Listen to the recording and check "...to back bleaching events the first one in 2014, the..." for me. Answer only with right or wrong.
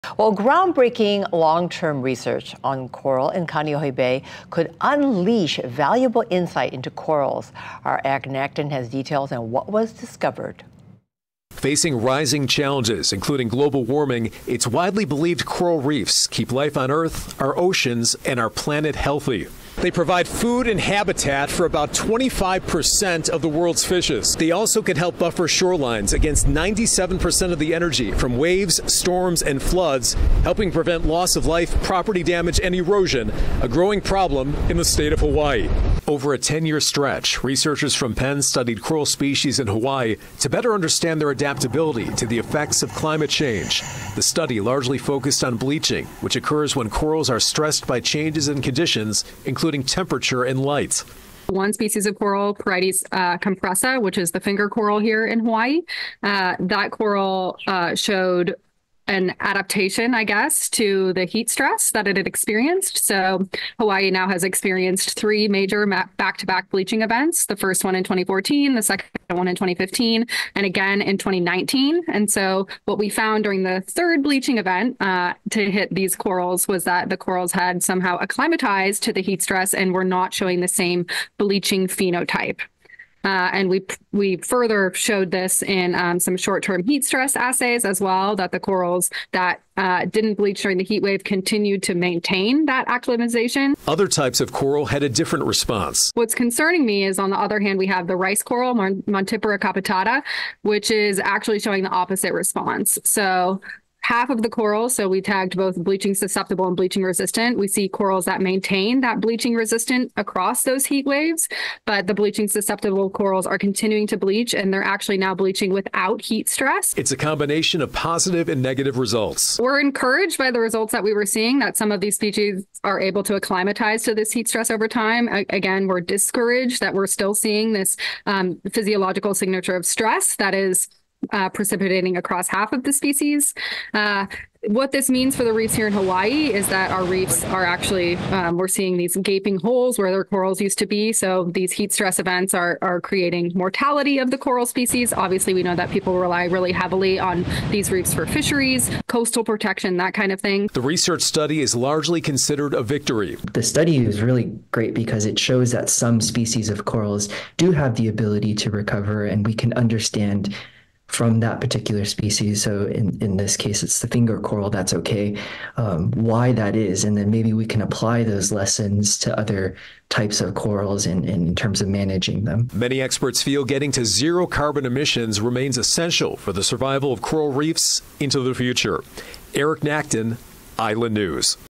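right.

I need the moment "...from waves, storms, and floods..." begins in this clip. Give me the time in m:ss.
0:28.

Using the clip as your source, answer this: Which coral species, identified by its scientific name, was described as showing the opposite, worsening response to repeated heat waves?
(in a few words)
Montipora capitata.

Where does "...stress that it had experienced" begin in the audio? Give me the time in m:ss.
1:01.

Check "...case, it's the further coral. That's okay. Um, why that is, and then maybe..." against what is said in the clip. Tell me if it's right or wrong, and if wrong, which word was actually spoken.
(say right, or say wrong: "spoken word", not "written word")
wrong: "finger", not "further".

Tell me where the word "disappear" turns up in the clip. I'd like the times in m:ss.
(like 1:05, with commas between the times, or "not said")
not said.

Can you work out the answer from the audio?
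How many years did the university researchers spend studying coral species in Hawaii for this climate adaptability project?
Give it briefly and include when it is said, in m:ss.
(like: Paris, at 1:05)
10 years, at 0:36.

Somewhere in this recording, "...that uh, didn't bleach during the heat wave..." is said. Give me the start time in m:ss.
1:29.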